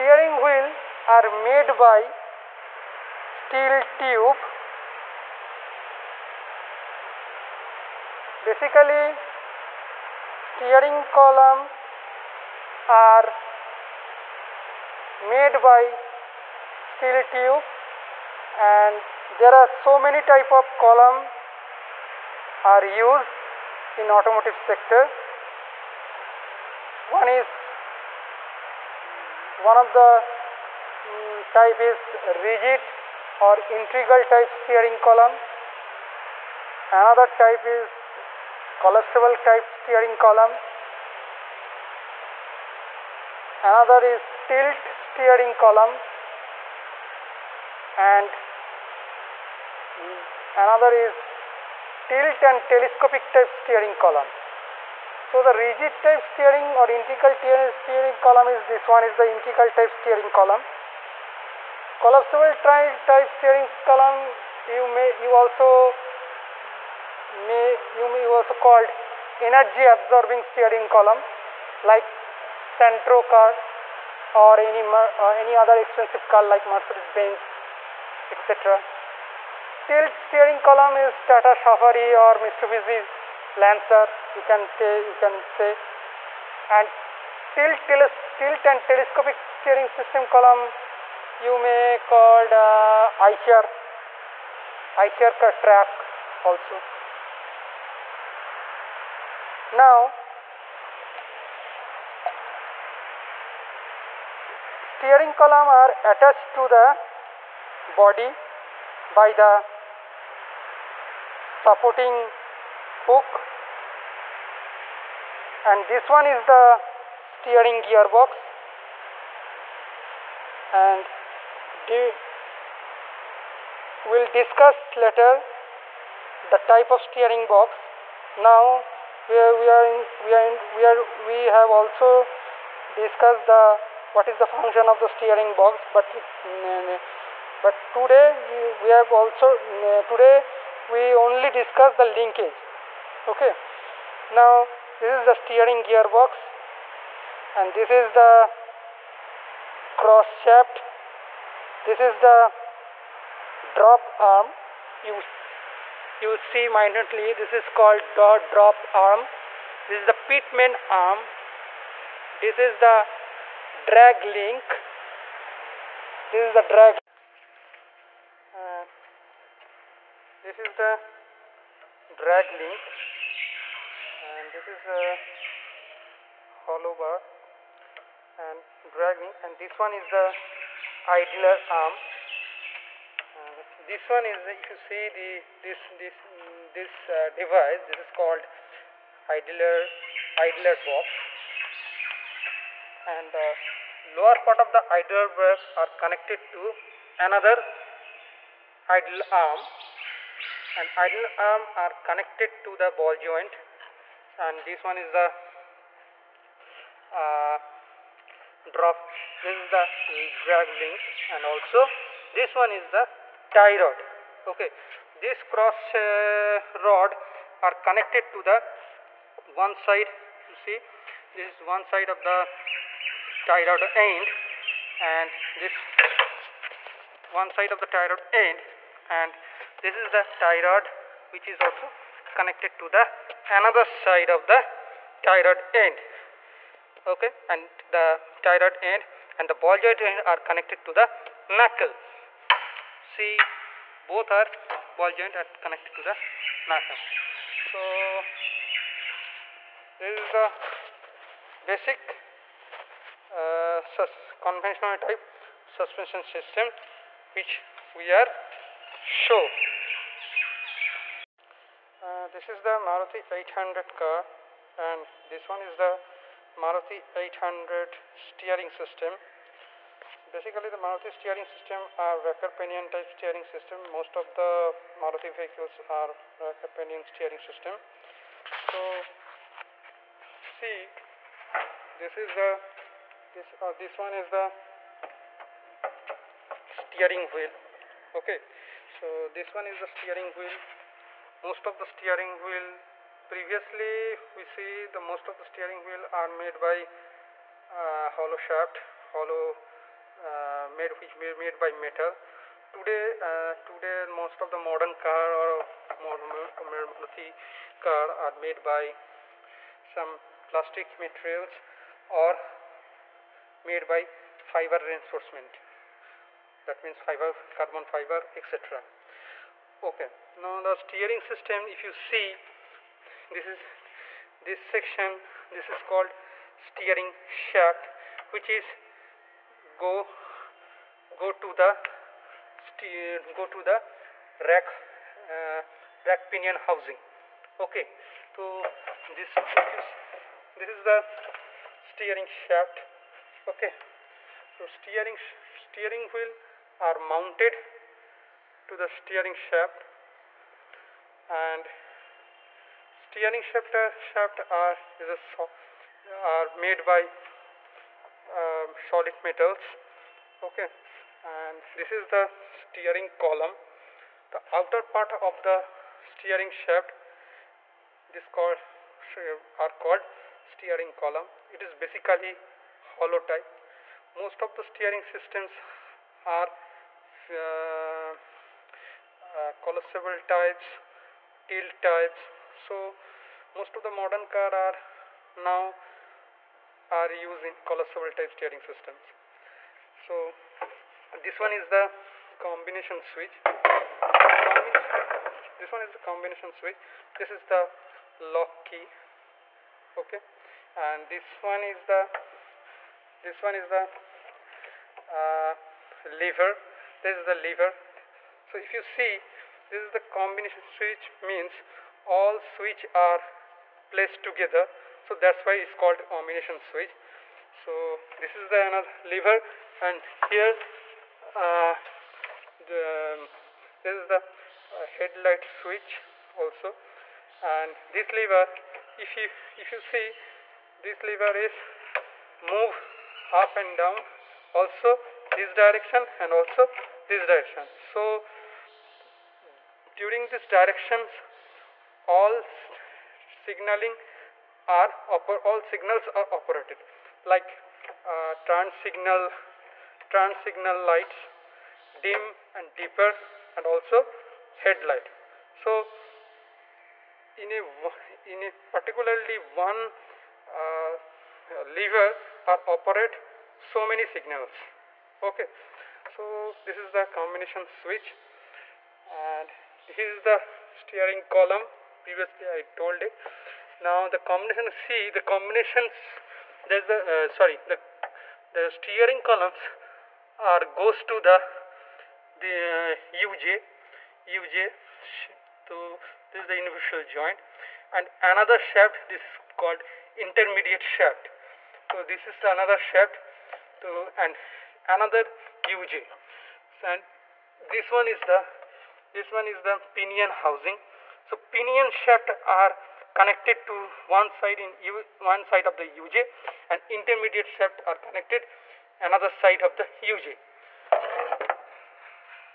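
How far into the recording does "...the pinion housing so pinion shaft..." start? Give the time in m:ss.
8:19.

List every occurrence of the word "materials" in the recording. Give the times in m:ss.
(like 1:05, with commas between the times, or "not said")
5:10.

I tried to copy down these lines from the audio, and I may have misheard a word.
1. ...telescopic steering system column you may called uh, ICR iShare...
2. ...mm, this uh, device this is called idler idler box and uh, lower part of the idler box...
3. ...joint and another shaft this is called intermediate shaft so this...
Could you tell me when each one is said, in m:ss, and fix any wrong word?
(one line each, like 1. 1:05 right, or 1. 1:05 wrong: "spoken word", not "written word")
1. 1:28 right
2. 3:06 right
3. 8:07 right.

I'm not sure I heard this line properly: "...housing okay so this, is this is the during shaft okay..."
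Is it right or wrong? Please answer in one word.
wrong.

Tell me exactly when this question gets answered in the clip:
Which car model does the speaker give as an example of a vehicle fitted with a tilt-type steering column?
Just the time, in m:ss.
1:21.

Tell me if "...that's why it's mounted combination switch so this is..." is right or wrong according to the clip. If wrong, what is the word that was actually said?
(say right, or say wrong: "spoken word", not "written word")
wrong: "called", not "mounted".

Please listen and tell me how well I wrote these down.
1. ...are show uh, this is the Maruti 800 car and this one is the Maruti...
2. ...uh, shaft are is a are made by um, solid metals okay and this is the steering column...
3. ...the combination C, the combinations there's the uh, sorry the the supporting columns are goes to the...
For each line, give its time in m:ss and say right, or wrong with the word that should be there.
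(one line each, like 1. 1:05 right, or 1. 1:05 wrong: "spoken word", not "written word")
1. 4:18 right
2. 5:53 right
3. 7:54 wrong: "steering", not "supporting".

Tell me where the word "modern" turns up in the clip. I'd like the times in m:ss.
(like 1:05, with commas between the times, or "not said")
5:04, 6:23.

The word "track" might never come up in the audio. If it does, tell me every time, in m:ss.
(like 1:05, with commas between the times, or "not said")
1:35.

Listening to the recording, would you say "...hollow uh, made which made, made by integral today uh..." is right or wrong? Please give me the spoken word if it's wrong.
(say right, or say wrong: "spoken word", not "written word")
wrong: "metal", not "integral".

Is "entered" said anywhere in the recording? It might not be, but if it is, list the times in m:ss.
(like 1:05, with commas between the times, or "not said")
not said.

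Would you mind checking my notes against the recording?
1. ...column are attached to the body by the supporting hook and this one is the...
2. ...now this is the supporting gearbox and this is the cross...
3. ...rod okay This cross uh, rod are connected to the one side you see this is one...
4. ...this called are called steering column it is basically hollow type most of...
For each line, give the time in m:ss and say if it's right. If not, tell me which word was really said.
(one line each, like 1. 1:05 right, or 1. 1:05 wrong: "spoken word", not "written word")
1. 1:45 right
2. 2:24 wrong: "steering", not "supporting"
3. 3:33 right
4. 6:08 right.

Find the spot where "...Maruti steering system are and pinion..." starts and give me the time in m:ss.
4:30.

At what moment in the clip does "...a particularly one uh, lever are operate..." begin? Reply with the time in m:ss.
7:38.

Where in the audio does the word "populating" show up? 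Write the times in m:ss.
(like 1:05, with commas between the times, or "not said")
not said.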